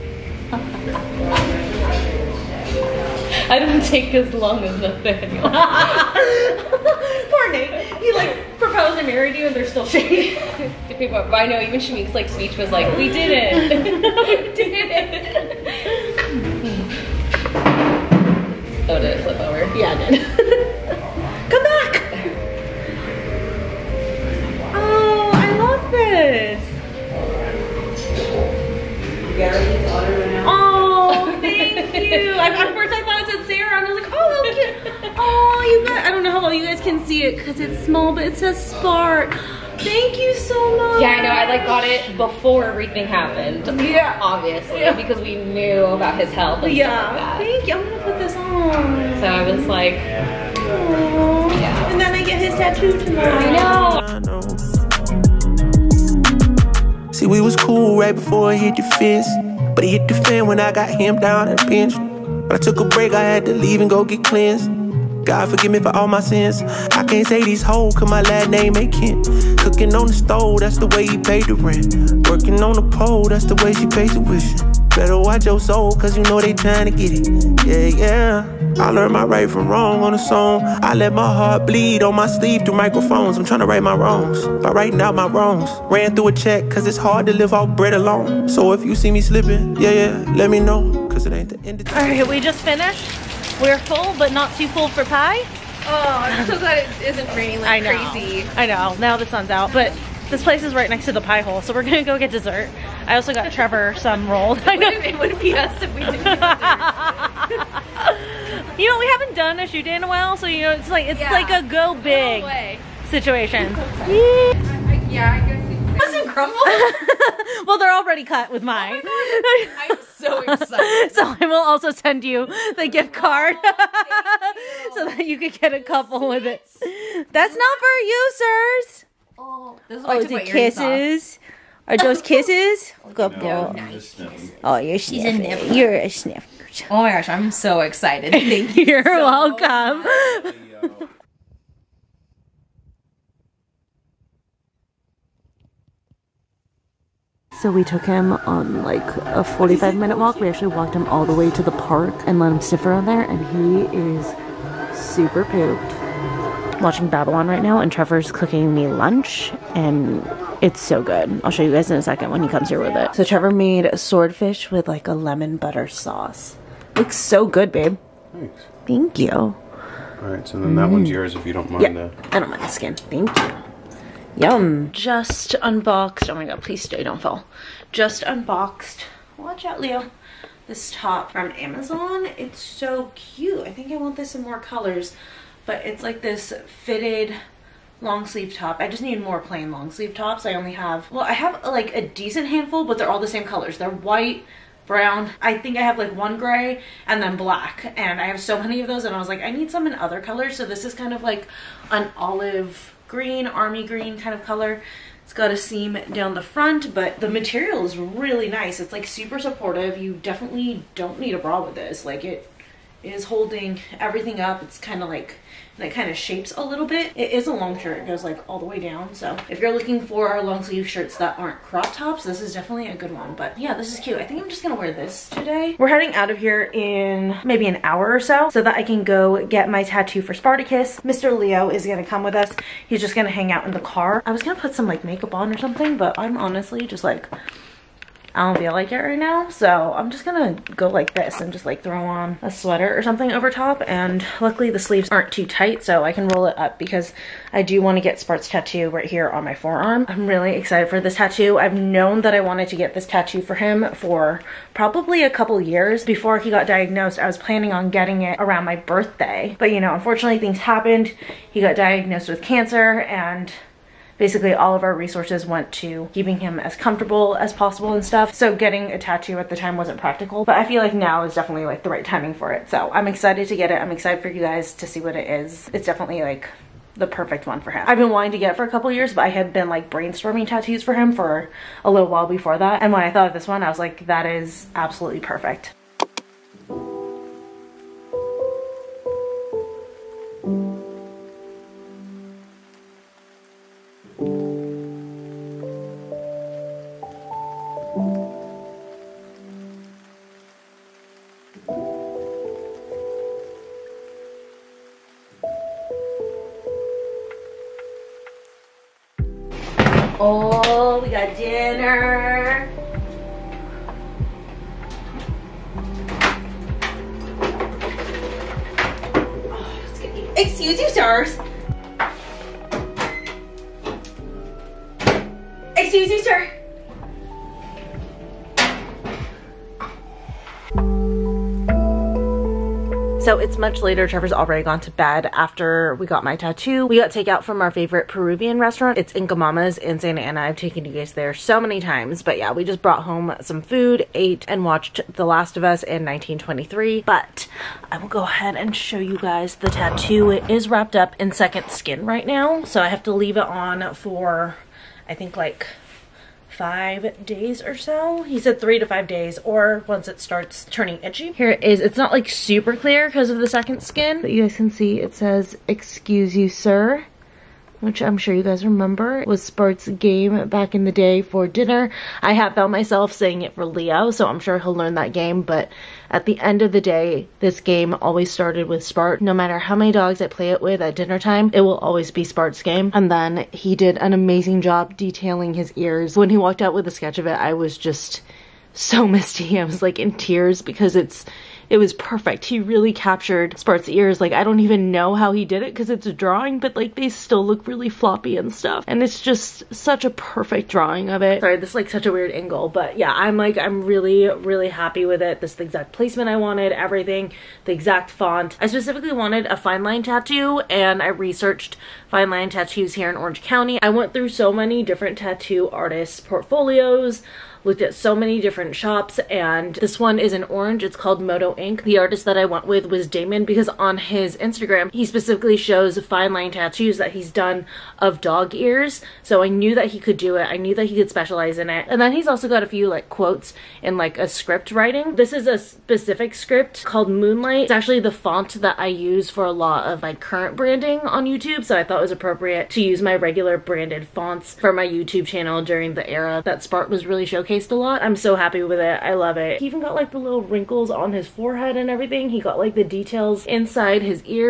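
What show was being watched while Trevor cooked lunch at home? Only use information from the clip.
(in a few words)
Babylon.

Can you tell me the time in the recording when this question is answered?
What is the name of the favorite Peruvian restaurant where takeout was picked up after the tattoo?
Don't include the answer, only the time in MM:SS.
05:39.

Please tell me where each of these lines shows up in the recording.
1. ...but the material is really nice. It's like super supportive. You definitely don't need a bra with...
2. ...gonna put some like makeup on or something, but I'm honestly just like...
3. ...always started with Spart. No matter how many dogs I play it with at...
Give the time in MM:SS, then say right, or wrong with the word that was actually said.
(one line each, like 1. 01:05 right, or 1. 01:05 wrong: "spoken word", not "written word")
1. 03:26 right
2. 03:54 right
3. 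06:17 right.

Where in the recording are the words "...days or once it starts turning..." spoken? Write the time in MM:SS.
05:59.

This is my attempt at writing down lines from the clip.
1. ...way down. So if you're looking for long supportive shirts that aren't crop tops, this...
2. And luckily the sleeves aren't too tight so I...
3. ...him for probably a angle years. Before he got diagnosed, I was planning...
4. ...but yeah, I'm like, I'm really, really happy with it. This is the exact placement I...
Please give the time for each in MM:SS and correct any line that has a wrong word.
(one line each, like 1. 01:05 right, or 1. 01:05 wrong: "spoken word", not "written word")
1. 03:38 wrong: "sleeve", not "supportive"
2. 04:03 right
3. 04:13 wrong: "couple", not "angle"
4. 06:42 right.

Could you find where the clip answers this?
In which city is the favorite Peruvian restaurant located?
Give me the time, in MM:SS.
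05:39.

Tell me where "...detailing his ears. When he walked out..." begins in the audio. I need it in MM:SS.
06:24.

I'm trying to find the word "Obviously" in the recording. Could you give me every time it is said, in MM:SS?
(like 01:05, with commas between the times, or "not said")
00:44.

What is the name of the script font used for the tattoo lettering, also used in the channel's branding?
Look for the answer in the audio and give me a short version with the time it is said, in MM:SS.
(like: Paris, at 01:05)
Moonlight, at 07:17.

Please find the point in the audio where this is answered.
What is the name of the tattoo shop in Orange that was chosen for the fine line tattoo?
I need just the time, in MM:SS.
07:01.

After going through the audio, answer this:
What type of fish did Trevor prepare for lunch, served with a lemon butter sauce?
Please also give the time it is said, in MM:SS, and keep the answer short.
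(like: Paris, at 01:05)
Swordfish, at 02:43.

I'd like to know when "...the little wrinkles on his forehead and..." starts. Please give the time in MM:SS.
07:30.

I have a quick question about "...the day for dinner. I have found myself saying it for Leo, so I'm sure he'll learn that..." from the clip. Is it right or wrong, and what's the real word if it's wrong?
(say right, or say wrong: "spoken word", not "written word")
right.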